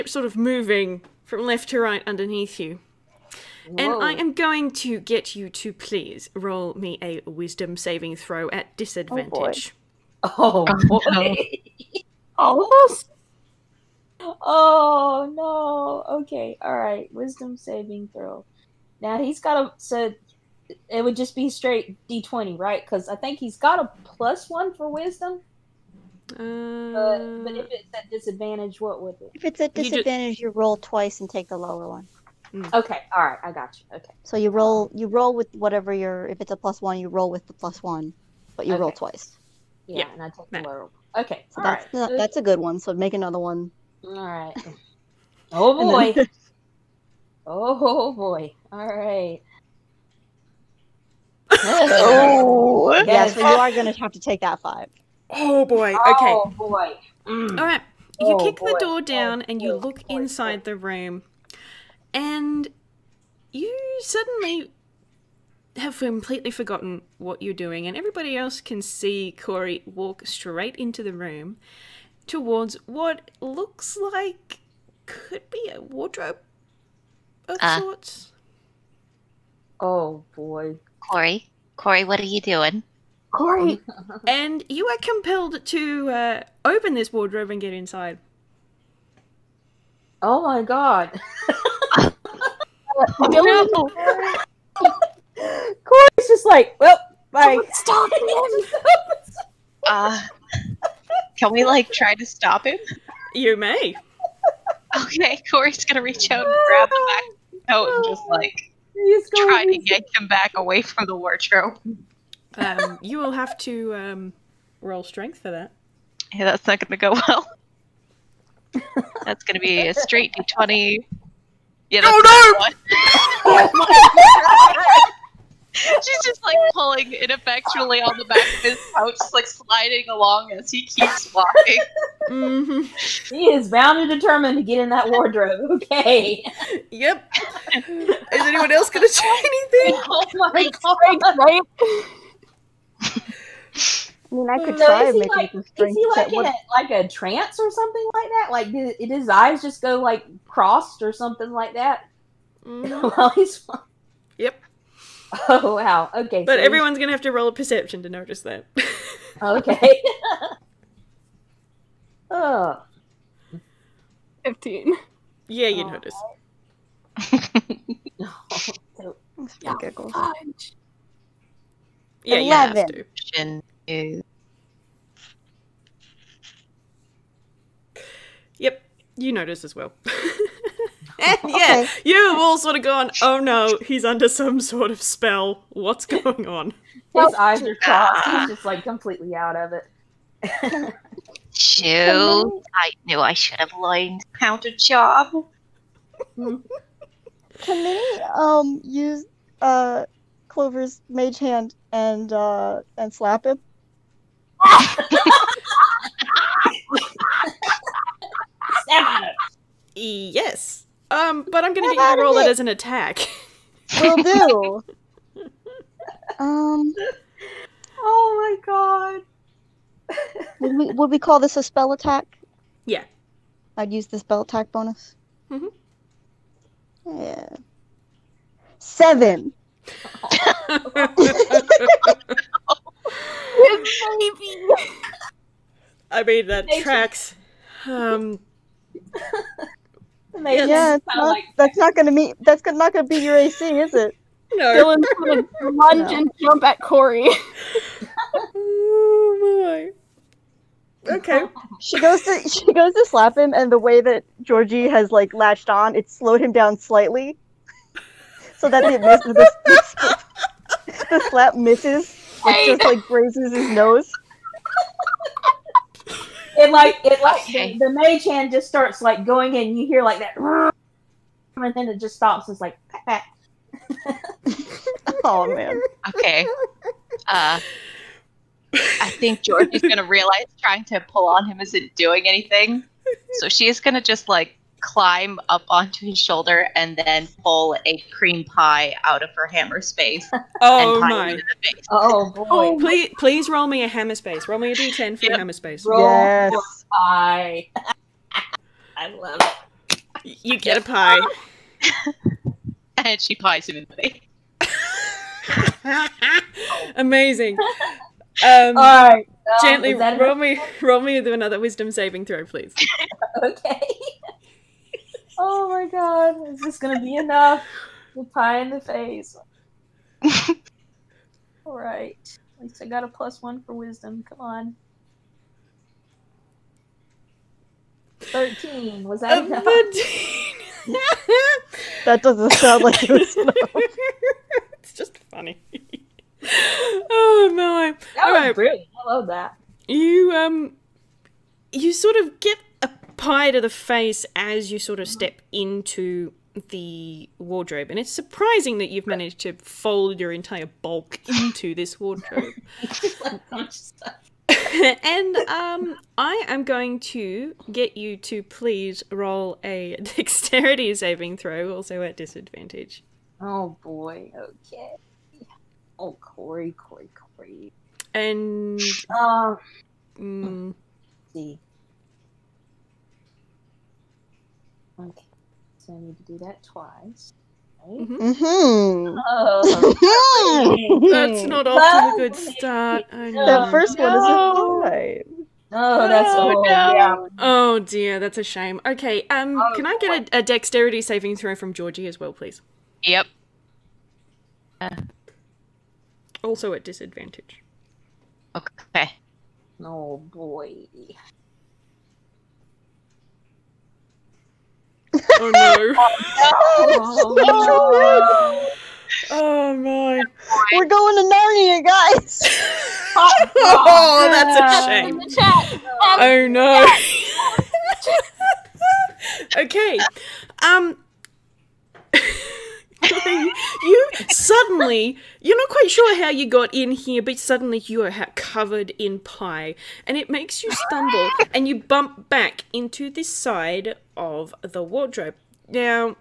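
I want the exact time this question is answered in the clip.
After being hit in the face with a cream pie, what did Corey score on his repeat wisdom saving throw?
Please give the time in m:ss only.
5:28.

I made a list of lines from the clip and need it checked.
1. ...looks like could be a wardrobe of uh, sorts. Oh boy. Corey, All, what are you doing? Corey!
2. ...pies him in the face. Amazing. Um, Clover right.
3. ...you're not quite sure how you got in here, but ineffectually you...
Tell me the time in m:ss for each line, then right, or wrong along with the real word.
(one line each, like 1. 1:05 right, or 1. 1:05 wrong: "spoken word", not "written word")
1. 1:13 wrong: "Corey", not "All"
2. 5:03 wrong: "All", not "Clover"
3. 7:05 wrong: "suddenly", not "ineffectually".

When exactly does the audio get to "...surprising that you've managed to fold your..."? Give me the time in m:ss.
5:48.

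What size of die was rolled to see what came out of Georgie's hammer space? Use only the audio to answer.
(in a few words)
d10.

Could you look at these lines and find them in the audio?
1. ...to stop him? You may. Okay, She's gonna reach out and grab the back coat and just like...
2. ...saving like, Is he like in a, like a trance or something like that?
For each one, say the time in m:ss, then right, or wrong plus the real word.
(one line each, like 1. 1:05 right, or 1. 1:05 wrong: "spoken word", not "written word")
1. 1:42 wrong: "Corey", not "She"
2. 2:25 wrong: "making", not "saving".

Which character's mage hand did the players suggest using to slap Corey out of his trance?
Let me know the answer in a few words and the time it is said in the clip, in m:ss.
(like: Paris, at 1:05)
Clover, at 3:20.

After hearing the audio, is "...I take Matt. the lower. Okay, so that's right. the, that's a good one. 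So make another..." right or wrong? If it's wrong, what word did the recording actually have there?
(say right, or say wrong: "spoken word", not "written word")
right.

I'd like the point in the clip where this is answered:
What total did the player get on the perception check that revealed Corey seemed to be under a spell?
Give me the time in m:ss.
2:44.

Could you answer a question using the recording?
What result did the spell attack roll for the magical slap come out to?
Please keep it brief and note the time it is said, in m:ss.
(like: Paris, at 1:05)
7, at 3:48.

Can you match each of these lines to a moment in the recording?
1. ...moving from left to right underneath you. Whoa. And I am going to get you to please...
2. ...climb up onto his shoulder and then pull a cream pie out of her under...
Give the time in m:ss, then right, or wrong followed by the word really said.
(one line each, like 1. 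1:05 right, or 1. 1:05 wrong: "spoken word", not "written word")
1. 0:00 right
2. 4:44 wrong: "hammer", not "under".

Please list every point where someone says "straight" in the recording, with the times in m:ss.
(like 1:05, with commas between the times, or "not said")
0:21, 1:10, 1:59.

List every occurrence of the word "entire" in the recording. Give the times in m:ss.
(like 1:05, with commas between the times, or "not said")
5:50.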